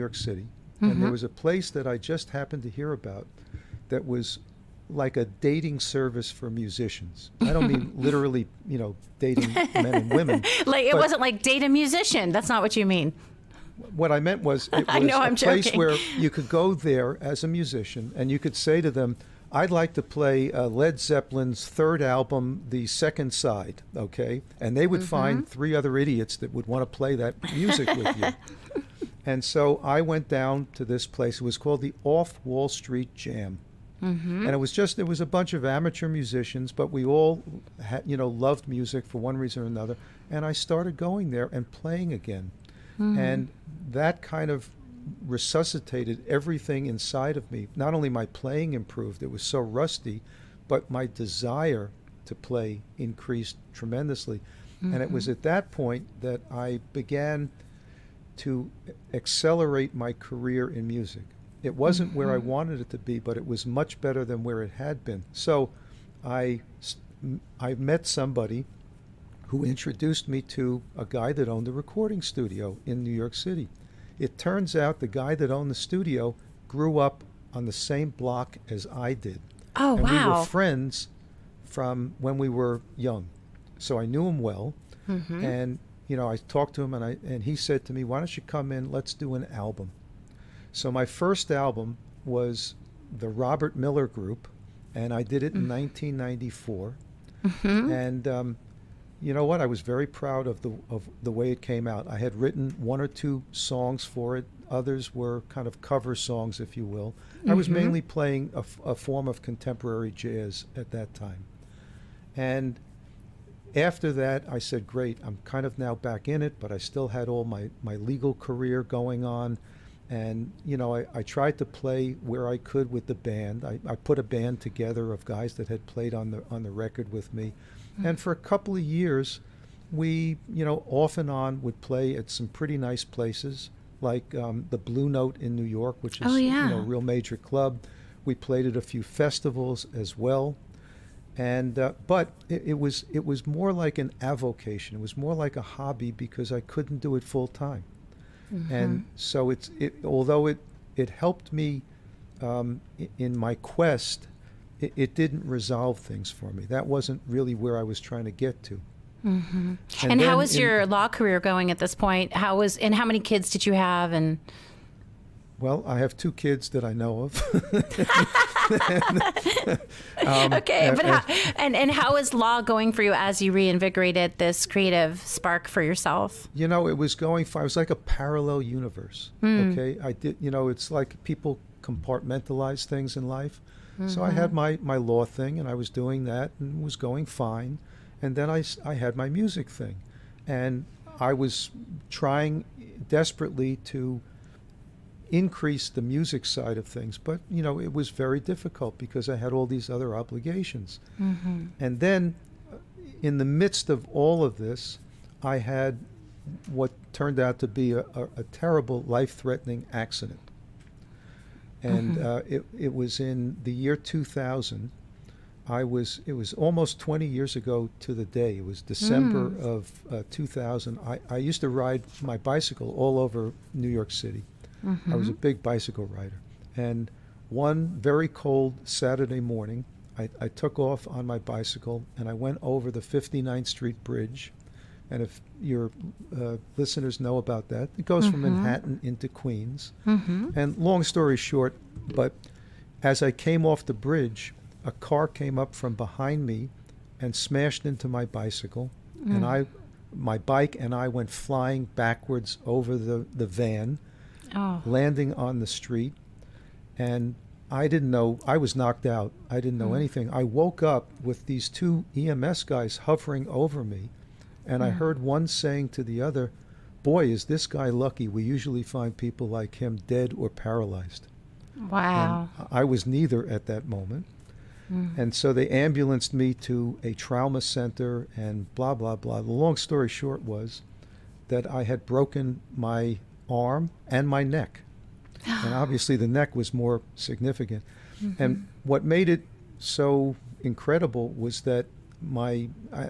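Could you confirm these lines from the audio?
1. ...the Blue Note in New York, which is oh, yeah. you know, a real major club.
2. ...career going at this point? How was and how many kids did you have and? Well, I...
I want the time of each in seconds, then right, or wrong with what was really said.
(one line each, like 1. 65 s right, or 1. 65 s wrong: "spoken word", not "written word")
1. 134 s right
2. 161 s right.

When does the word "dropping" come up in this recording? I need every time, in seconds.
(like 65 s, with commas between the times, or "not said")
not said.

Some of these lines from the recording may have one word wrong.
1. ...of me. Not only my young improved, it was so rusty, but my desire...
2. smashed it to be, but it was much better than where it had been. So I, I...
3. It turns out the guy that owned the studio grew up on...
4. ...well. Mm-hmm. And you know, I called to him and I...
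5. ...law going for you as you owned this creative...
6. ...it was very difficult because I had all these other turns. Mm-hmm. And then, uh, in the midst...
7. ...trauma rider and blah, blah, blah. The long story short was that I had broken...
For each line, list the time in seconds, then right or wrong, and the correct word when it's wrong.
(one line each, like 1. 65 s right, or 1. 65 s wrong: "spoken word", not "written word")
1. 47 s wrong: "playing", not "young"
2. 62 s wrong: "wanted", not "smashed"
3. 74 s right
4. 84 s wrong: "talked", not "called"
5. 172 s wrong: "reinvigorated", not "owned"
6. 197 s wrong: "obligations", not "turns"
7. 277 s wrong: "center", not "rider".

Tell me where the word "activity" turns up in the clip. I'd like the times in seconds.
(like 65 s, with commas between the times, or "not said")
not said.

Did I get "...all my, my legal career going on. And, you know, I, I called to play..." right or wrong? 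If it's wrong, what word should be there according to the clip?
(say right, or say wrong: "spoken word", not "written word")
wrong: "tried", not "called".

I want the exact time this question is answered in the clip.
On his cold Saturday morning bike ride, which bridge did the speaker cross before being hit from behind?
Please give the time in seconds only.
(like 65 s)
232 s.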